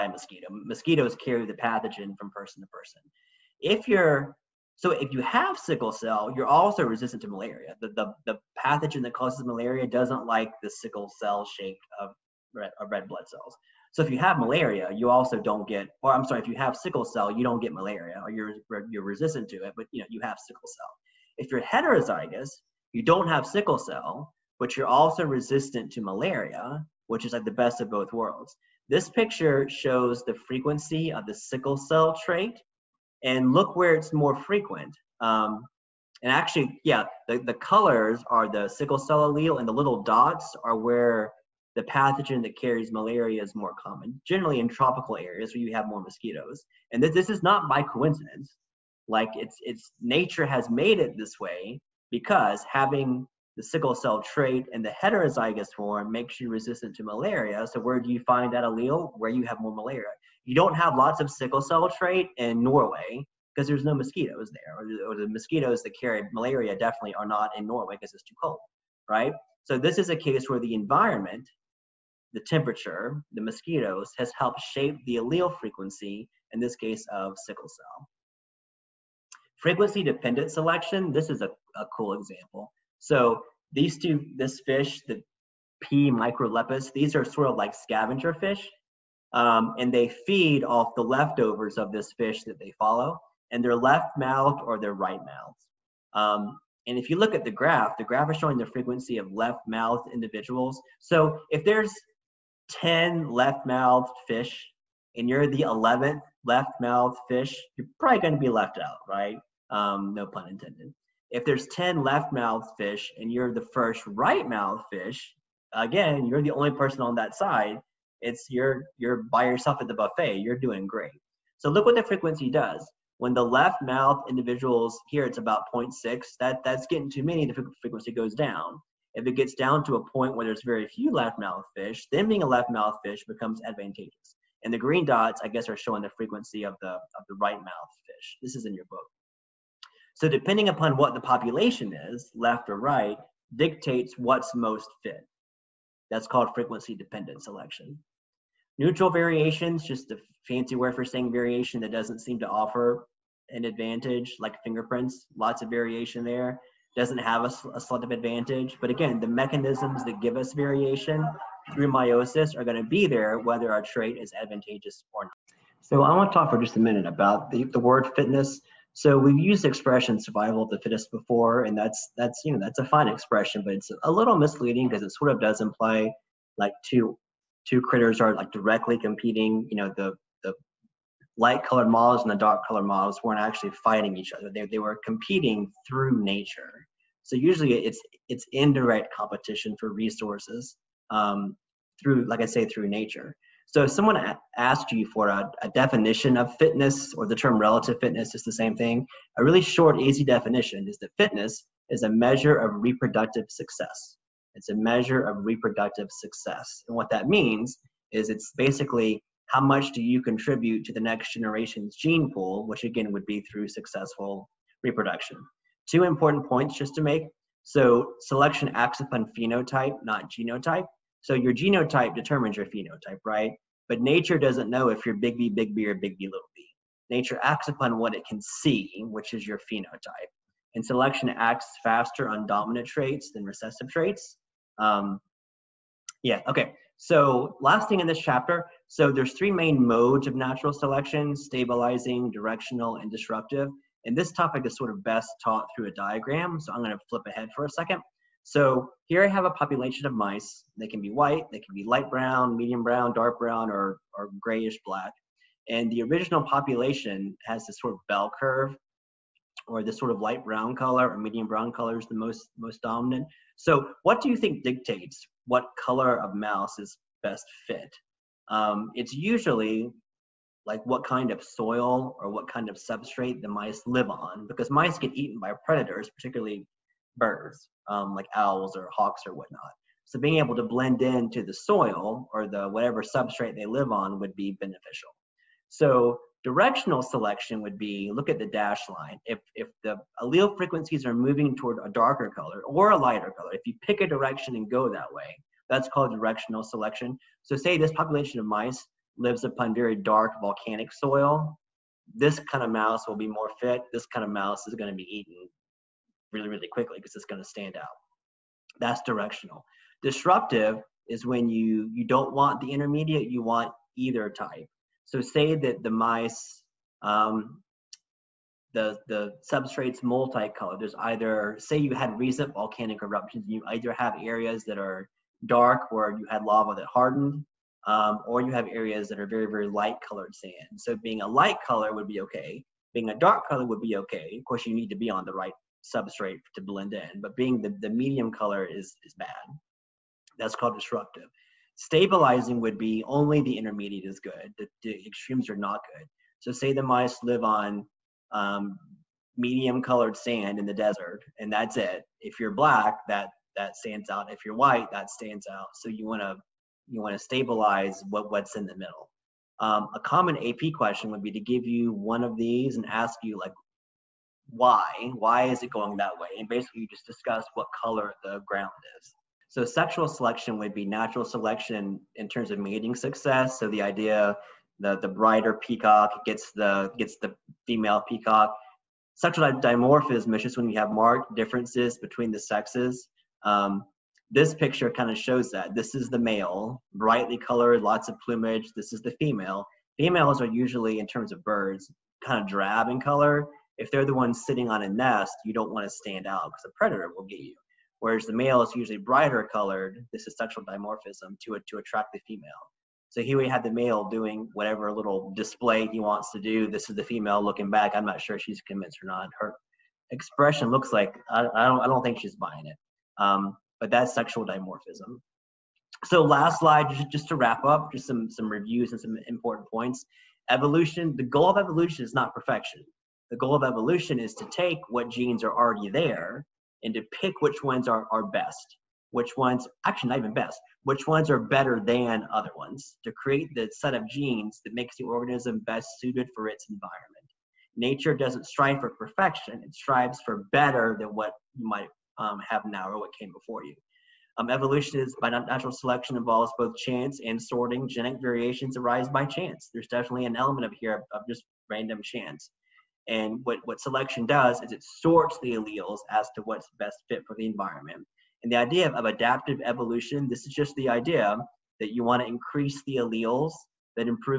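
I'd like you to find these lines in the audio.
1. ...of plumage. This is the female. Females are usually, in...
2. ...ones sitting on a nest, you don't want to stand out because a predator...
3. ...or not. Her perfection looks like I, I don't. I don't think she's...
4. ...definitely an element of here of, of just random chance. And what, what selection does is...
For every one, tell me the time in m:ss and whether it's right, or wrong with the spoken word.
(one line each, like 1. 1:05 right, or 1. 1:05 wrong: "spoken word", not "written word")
1. 6:28 right
2. 6:34 right
3. 6:49 wrong: "expression", not "perfection"
4. 7:29 right.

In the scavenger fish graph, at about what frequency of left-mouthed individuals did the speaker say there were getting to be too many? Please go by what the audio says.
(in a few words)
0.6.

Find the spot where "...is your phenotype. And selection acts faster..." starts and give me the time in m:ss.
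3:49.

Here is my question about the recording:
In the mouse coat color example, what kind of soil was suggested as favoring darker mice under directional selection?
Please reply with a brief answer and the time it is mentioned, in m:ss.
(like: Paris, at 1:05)
Dark volcanic soil, at 4:59.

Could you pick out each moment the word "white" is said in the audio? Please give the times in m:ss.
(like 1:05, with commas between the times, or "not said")
4:11, 5:54.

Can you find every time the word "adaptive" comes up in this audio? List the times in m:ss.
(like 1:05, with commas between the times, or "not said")
7:39.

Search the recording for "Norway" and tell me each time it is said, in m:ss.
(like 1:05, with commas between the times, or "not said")
1:02, 1:07.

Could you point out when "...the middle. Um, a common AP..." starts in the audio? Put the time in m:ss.
5:58.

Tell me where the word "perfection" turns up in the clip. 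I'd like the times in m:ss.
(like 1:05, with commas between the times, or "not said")
7:02, 7:18.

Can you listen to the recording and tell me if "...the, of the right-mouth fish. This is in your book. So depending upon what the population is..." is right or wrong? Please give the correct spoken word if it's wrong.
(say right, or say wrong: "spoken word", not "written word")
right.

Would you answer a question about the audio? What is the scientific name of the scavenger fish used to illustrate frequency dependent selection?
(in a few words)
P. microlepis.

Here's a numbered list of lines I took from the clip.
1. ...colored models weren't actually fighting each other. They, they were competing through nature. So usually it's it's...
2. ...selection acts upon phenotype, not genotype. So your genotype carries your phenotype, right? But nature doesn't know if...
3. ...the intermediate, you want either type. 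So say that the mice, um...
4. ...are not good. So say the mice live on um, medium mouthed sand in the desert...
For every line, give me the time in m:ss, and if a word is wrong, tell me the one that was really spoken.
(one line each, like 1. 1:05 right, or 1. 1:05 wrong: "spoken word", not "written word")
1. 3:02 right
2. 3:38 wrong: "determines", not "carries"
3. 5:12 right
4. 5:45 wrong: "colored", not "mouthed".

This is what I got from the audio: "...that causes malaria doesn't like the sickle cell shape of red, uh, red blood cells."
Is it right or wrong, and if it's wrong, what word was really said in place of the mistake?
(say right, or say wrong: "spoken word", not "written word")
right.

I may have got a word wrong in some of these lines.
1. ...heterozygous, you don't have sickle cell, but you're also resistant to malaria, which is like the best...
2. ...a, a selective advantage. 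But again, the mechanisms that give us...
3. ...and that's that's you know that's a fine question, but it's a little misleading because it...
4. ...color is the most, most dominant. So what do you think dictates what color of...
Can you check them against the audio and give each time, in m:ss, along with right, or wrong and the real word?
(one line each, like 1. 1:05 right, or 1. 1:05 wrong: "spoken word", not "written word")
1. 0:21 right
2. 2:37 right
3. 2:51 wrong: "expression", not "question"
4. 4:21 right.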